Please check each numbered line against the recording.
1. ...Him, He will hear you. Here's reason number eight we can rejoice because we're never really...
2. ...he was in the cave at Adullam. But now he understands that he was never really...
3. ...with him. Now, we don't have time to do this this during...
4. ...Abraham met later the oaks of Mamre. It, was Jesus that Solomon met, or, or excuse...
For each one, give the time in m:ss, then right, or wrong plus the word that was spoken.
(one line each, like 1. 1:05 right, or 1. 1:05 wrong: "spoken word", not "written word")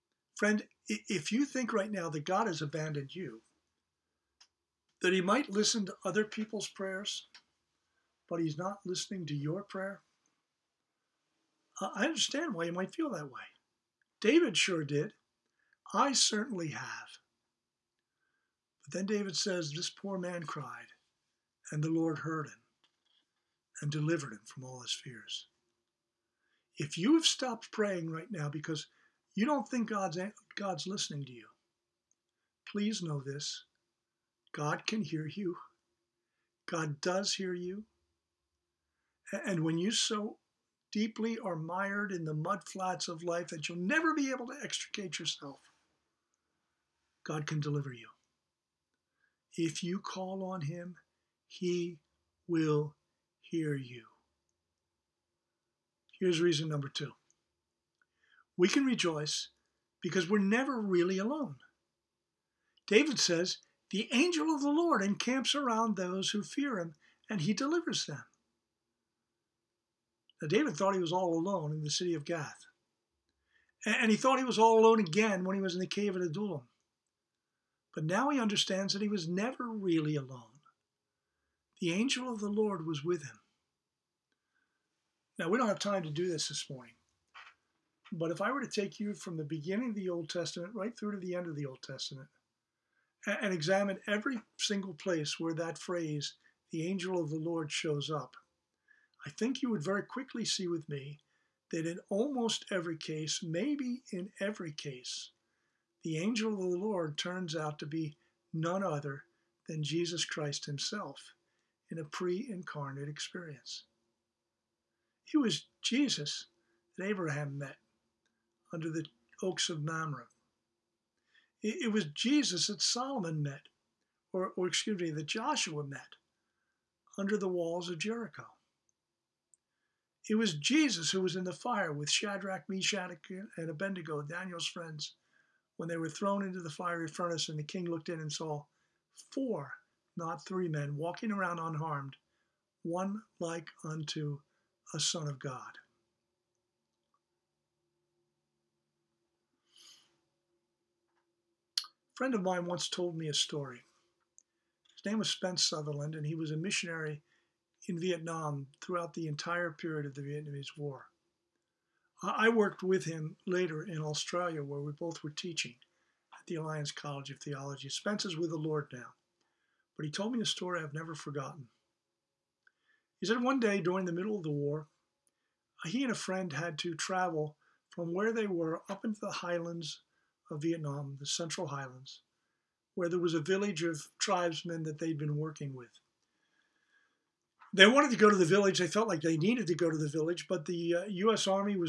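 1. 0:50 wrong: "two", not "eight"
2. 1:15 right
3. 1:23 wrong: "morning", not "during"
4. 1:57 wrong: "under", not "later".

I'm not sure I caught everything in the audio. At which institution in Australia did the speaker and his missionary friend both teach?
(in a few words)
Alliance College of Theology.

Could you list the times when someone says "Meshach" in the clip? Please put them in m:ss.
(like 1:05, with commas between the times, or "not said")
2:12.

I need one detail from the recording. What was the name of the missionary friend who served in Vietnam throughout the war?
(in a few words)
Spence Sutherland.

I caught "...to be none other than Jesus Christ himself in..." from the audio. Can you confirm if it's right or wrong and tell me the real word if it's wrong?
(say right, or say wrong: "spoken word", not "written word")
right.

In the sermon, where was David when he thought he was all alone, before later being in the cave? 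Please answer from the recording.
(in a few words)
Gath.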